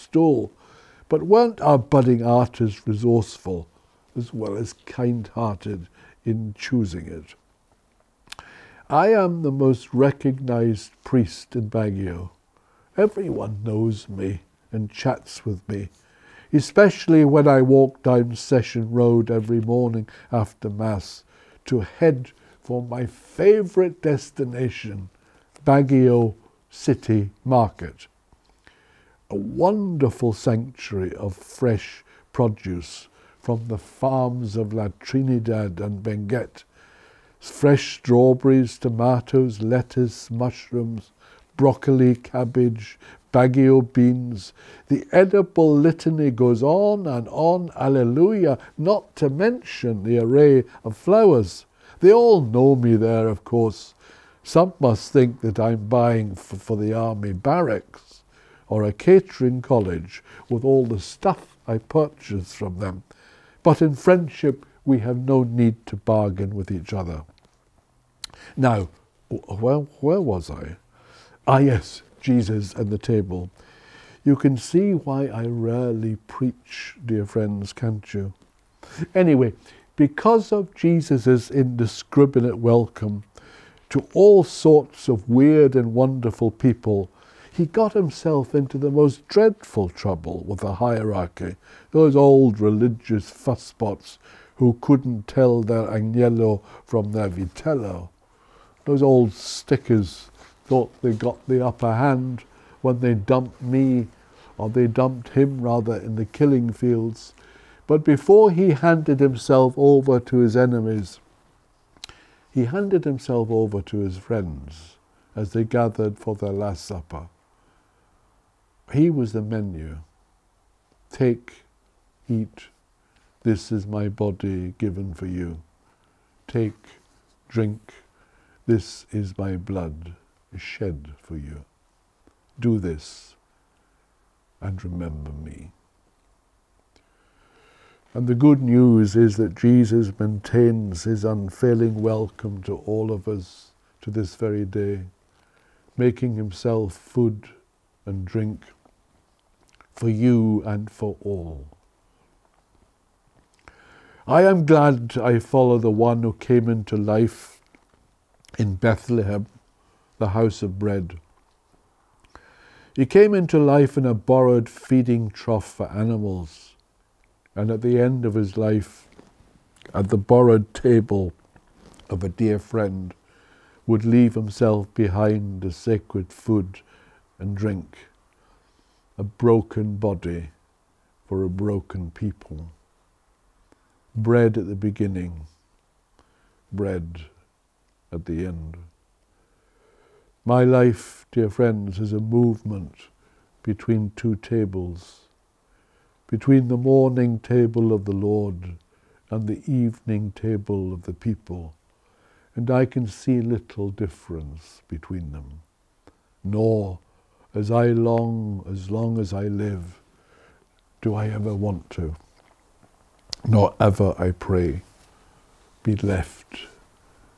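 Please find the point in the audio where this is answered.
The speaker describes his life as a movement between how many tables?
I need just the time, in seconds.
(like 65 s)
194 s.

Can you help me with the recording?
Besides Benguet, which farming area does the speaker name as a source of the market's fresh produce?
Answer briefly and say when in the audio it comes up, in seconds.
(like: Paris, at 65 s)
La Trinidad, at 34 s.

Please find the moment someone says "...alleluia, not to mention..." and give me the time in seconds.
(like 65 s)
47 s.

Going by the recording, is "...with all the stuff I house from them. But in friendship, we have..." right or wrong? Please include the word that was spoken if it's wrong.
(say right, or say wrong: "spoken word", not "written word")
wrong: "purchase", not "house".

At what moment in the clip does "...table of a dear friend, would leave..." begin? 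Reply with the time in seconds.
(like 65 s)
170 s.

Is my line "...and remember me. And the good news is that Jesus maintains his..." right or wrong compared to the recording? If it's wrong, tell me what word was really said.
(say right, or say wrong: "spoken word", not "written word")
right.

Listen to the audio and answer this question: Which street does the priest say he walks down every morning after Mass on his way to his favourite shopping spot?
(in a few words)
Session Road.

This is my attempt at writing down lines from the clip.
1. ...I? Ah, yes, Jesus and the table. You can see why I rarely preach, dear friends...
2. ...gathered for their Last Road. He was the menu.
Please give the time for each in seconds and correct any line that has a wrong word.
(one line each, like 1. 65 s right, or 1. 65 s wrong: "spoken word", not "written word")
1. 70 s right
2. 115 s wrong: "Supper", not "Road".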